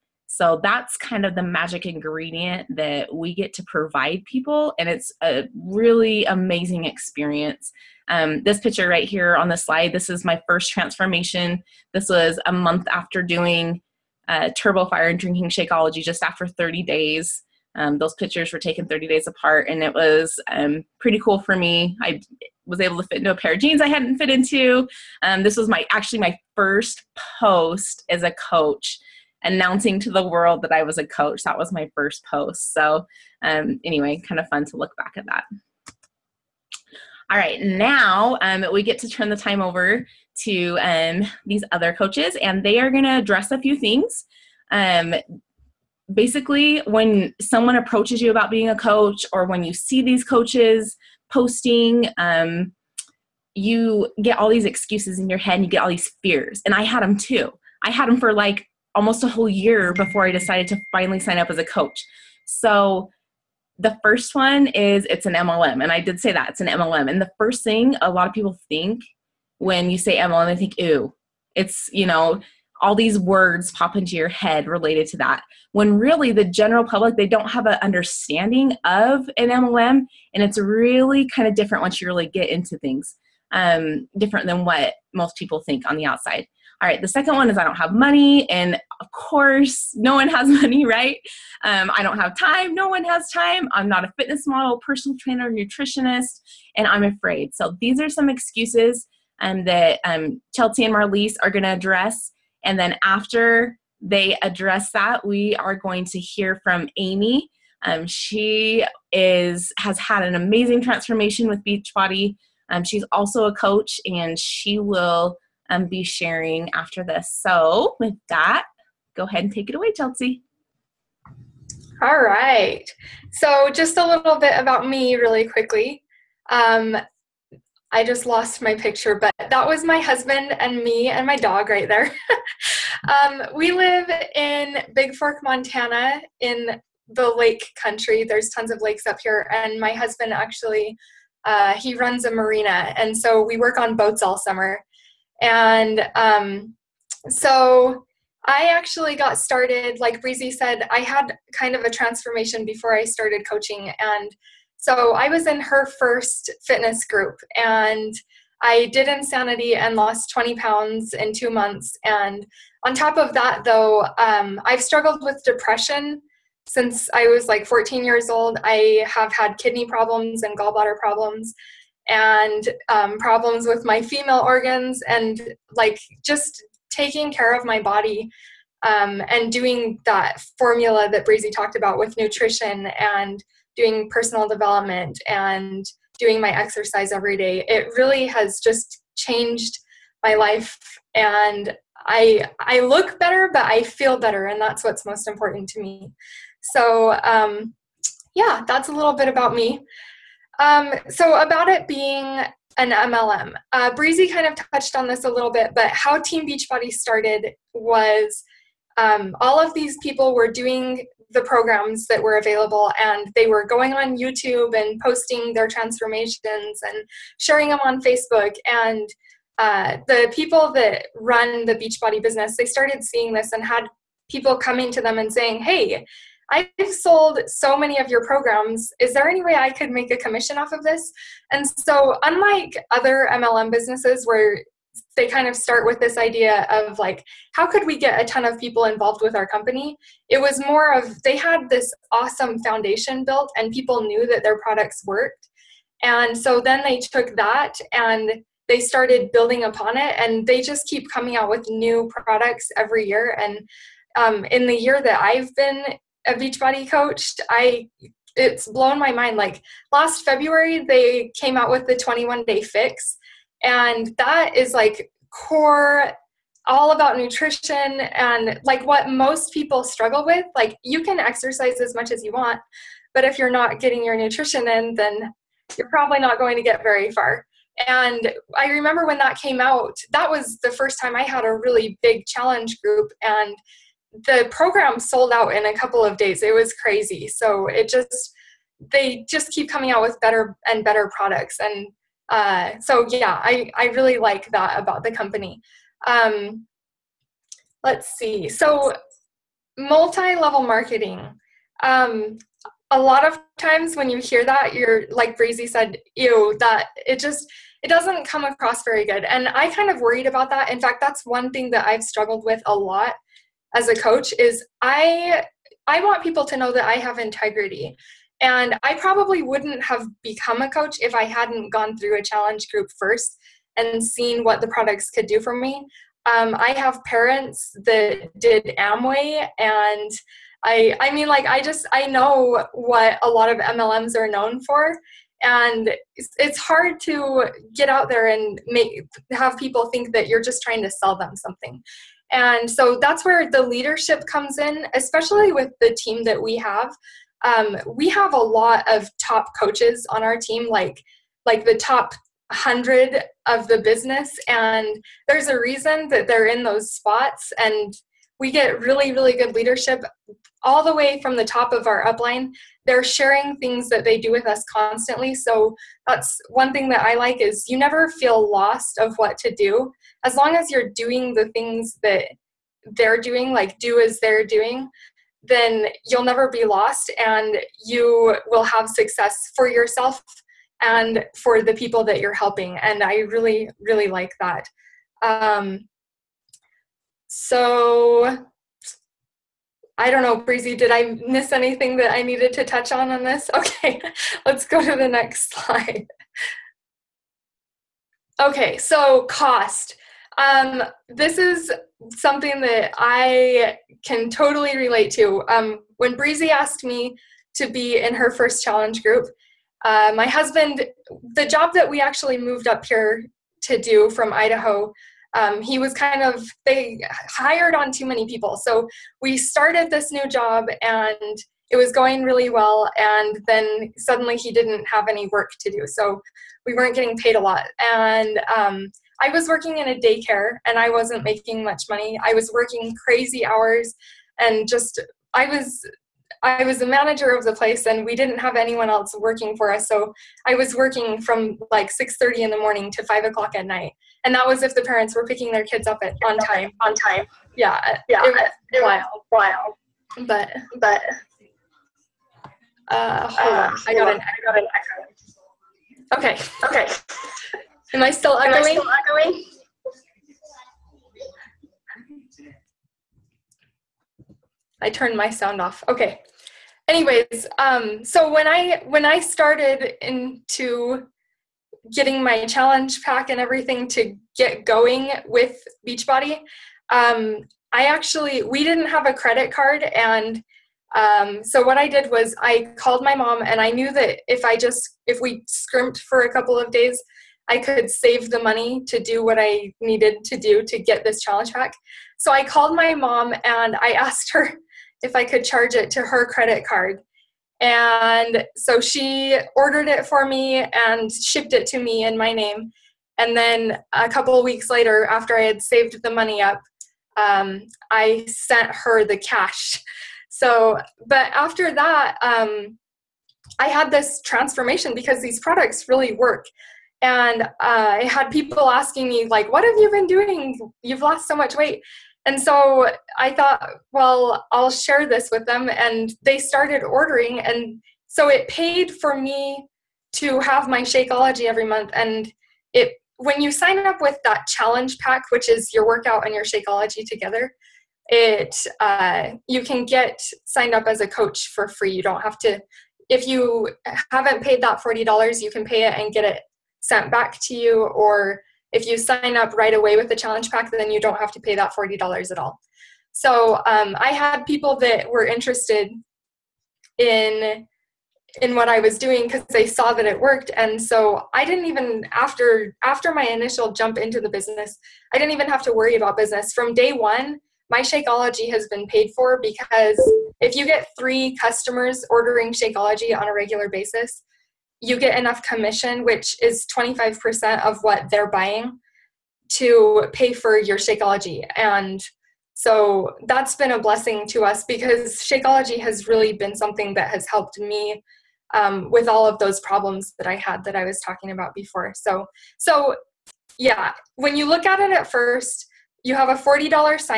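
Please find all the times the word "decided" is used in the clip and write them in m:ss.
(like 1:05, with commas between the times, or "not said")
1:00.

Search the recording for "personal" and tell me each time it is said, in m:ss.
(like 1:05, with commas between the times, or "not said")
1:34, 3:04.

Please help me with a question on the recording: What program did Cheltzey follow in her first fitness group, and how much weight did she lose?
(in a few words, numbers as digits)
Insanity, 20 pounds.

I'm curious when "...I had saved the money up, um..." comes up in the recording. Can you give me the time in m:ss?
8:25.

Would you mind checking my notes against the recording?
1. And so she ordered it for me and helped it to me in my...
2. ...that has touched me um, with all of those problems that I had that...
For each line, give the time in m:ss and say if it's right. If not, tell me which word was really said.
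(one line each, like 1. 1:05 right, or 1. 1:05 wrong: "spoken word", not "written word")
1. 8:17 wrong: "shipped", not "helped"
2. 9:46 wrong: "helped", not "touched".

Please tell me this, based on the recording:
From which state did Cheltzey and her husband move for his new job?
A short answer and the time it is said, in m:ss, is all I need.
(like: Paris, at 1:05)
Idaho, at 6:54.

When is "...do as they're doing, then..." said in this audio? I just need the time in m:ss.
6:13.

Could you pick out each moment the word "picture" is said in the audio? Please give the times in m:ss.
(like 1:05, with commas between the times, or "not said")
0:08, 0:18, 2:08.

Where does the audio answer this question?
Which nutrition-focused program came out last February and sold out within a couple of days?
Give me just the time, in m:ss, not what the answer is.
4:21.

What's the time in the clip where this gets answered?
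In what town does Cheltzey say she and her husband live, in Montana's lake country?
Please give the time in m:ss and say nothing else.
2:14.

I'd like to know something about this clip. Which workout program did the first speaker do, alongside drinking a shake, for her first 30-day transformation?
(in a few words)
Turbo Fire.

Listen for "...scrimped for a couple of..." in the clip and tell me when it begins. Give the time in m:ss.
8:05.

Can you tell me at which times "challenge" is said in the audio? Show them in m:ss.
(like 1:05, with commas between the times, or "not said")
4:42, 5:22, 6:48, 7:52, 8:11, 8:54, 9:10.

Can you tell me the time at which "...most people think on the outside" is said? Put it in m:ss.
1:25.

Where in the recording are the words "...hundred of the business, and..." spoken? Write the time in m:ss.
5:52.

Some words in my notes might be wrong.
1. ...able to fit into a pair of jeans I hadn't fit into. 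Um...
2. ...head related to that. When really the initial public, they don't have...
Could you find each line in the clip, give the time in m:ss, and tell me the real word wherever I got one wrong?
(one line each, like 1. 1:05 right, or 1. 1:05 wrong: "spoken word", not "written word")
1. 0:22 right
2. 1:14 wrong: "general", not "initial".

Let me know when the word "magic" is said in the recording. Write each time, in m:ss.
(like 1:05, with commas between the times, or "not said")
0:01.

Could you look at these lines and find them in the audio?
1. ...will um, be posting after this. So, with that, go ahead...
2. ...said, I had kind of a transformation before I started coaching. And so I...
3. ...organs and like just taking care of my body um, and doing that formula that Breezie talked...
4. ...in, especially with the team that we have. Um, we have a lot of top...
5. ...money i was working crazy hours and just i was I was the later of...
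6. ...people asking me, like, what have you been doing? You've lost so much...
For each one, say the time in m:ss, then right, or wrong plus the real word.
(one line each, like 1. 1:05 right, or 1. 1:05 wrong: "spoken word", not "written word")
1. 1:54 wrong: "sharing", not "posting"
2. 2:30 right
3. 2:54 right
4. 5:44 right
5. 7:11 wrong: "manager", not "later"
6. 8:38 right.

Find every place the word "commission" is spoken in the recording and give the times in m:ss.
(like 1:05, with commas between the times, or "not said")
3:50, 9:35.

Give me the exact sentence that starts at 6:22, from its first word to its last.
And I really, really like that.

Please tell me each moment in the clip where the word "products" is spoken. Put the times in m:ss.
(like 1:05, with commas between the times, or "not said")
4:04, 4:12, 4:51, 5:24, 8:35.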